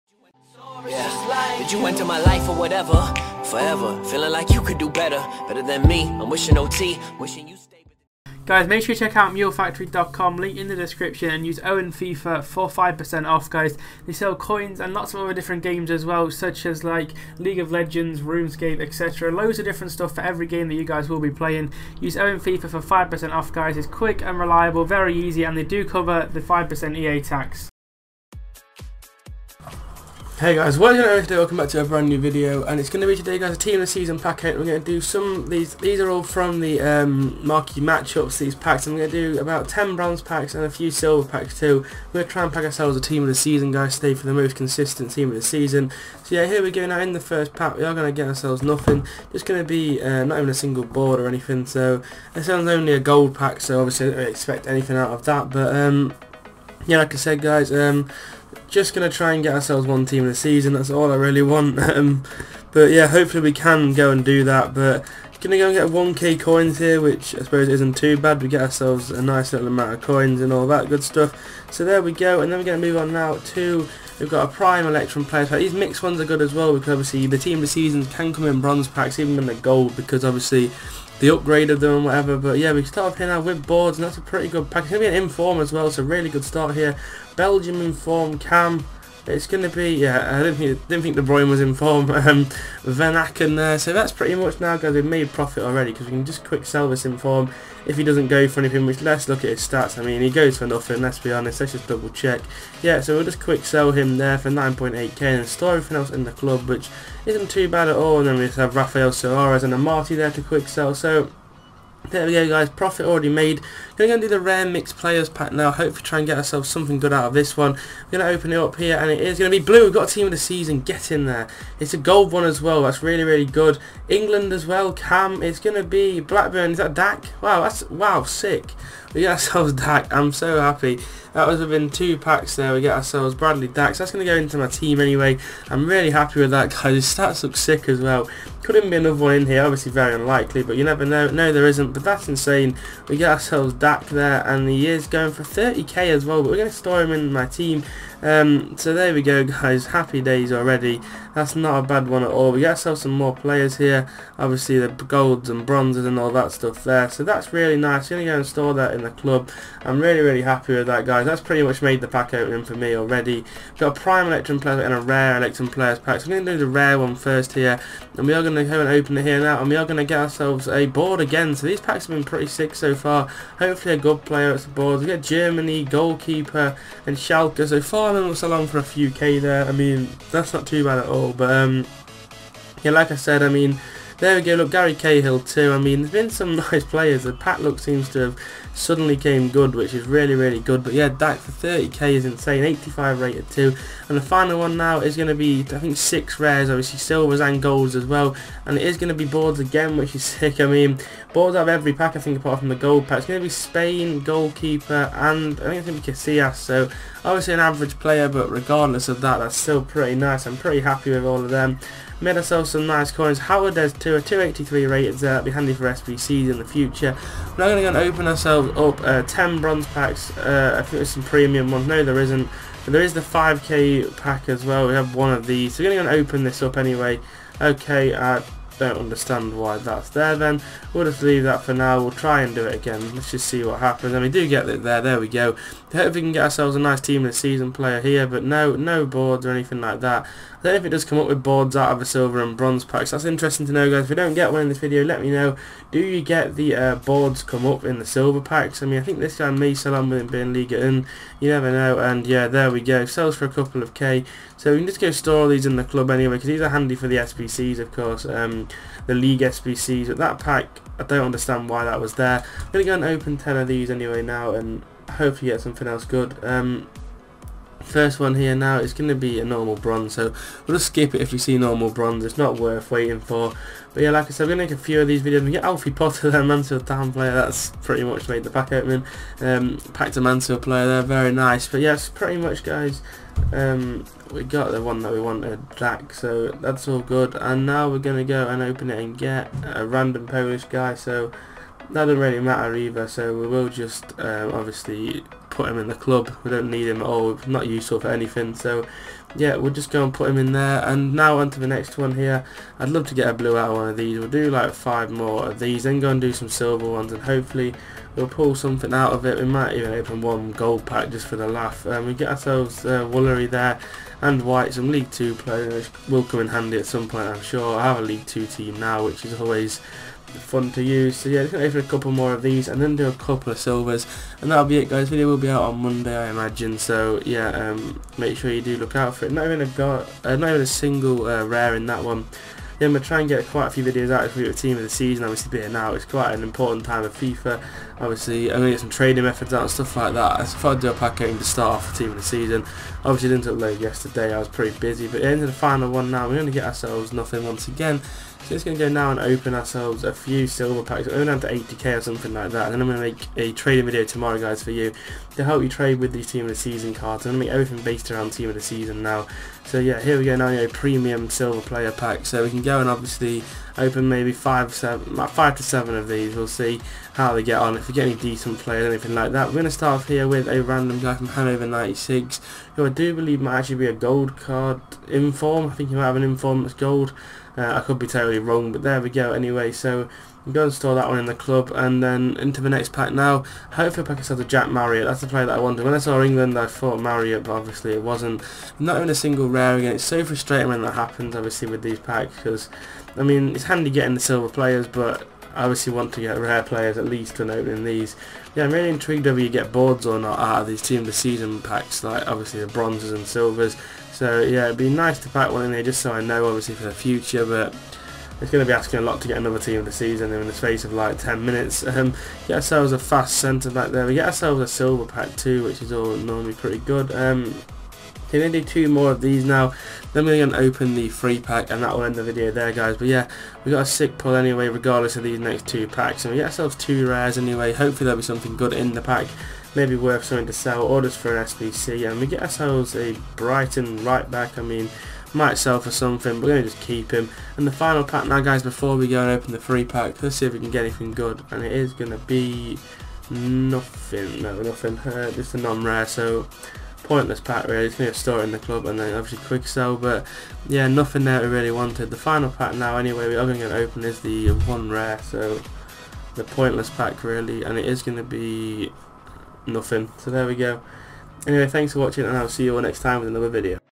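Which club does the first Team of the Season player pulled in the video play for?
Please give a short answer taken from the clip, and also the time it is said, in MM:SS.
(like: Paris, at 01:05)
Blackburn, at 02:06.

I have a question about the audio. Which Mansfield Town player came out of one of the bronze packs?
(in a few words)
Alfie Potter.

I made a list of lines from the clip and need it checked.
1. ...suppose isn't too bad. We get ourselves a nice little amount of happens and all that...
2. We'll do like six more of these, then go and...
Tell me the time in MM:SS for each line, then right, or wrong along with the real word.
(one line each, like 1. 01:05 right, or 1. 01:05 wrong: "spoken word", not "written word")
1. 01:07 wrong: "coins", not "happens"
2. 05:04 wrong: "five", not "six".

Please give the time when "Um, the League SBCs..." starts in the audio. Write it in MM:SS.
04:18.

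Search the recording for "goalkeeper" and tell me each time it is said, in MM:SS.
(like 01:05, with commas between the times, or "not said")
02:55, 03:24.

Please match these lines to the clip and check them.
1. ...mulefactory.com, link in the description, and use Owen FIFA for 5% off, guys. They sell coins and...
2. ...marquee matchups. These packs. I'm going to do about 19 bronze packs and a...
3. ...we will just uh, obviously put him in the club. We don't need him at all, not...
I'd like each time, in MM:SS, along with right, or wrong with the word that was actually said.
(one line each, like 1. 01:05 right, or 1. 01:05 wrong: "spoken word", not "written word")
1. 00:09 right
2. 00:37 wrong: "10", not "19"
3. 04:53 right.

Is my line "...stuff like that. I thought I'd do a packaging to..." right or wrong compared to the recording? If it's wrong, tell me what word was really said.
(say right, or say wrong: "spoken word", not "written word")
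right.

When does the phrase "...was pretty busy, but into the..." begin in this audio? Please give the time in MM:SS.
05:44.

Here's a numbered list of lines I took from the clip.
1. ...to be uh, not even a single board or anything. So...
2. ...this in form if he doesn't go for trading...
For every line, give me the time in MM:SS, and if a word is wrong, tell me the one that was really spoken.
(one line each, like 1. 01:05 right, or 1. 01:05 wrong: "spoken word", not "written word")
1. 00:49 right
2. 01:36 wrong: "anything", not "trading".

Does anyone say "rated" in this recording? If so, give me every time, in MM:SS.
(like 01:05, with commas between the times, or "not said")
03:13, 03:34.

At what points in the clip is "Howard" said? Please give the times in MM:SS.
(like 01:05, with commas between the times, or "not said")
03:33.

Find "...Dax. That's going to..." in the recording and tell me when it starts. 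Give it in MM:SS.
02:13.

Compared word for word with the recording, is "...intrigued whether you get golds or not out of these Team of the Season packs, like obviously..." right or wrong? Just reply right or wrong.
wrong.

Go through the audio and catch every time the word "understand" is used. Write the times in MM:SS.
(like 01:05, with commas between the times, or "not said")
03:48, 04:21.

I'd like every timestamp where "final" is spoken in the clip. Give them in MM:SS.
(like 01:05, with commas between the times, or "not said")
03:14, 05:45, 07:17, 07:32.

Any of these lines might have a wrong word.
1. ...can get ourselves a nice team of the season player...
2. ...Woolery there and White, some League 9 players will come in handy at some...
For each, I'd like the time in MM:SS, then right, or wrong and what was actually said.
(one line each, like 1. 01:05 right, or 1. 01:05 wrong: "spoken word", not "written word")
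1. 03:56 right
2. 05:13 wrong: "2", not "9".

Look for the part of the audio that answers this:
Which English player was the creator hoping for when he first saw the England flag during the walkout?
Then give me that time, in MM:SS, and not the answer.
06:24.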